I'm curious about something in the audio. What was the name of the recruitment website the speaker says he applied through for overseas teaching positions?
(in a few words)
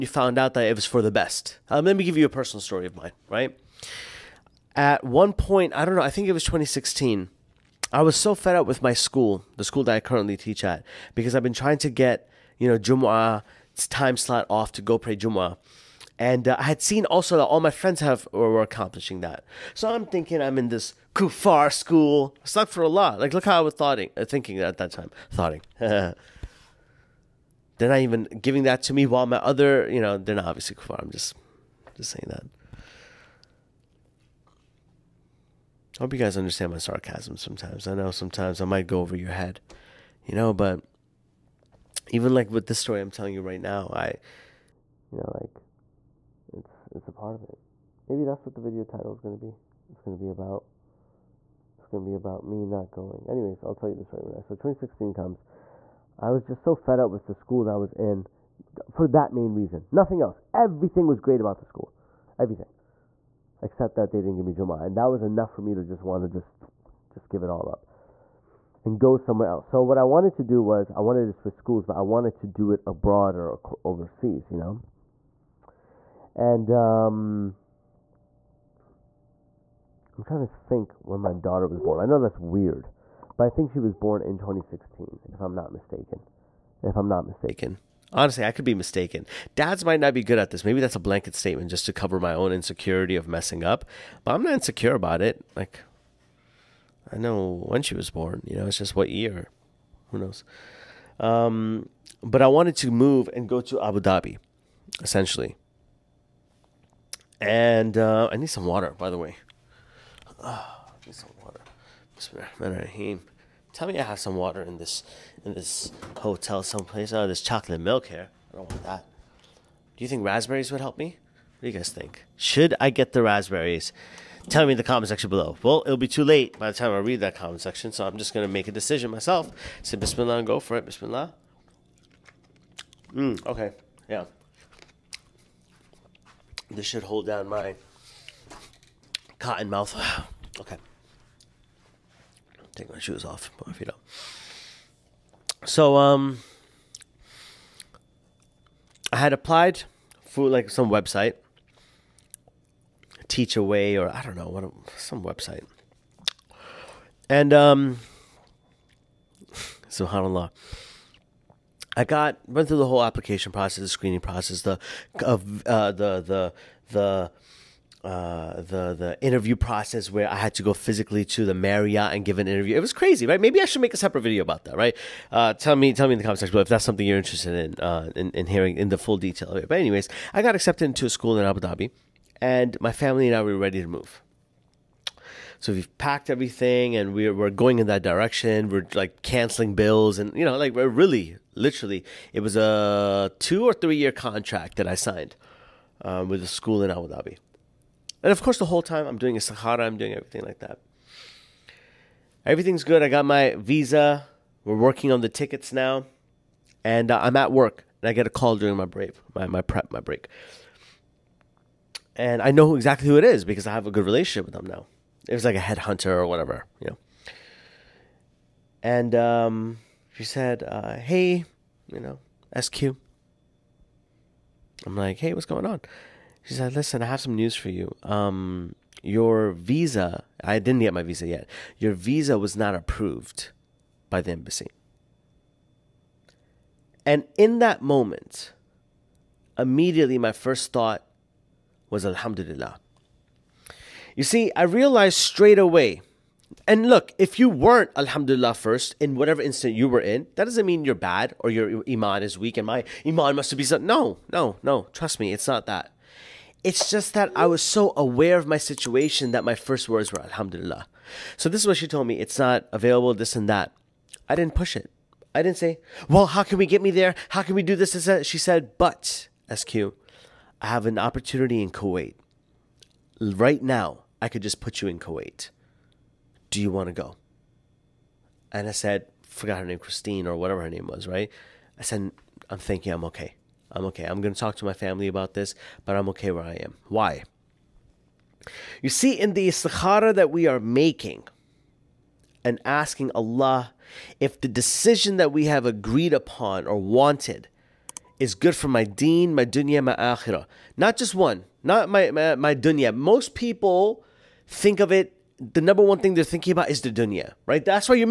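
Teach Away.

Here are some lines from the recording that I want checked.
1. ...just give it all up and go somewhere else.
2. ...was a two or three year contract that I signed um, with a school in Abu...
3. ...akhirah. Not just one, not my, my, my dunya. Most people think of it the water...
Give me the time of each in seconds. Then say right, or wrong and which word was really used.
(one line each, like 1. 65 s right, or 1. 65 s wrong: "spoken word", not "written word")
1. 67 s right
2. 192 s right
3. 299 s wrong: "number", not "water".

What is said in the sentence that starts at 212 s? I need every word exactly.
And I know exactly who it is because I have a good relationship with them now.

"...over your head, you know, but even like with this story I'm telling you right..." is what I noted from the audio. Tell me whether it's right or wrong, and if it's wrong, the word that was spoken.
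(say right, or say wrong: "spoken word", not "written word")
right.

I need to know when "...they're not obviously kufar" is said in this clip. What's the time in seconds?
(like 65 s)
30 s.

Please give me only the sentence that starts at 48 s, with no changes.
Maybe that's what the video title is going to be.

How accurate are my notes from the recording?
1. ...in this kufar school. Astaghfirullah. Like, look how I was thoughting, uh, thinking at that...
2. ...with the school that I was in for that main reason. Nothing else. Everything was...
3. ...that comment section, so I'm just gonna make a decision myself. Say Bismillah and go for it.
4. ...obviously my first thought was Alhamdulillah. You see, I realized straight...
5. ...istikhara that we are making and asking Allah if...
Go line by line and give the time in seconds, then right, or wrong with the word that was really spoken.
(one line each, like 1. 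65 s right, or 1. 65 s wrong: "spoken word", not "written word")
1. 20 s right
2. 57 s right
3. 127 s right
4. 239 s wrong: "immediately", not "obviously"
5. 289 s right.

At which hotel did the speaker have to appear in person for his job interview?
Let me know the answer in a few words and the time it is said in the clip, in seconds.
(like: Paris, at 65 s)
Marriott, at 171 s.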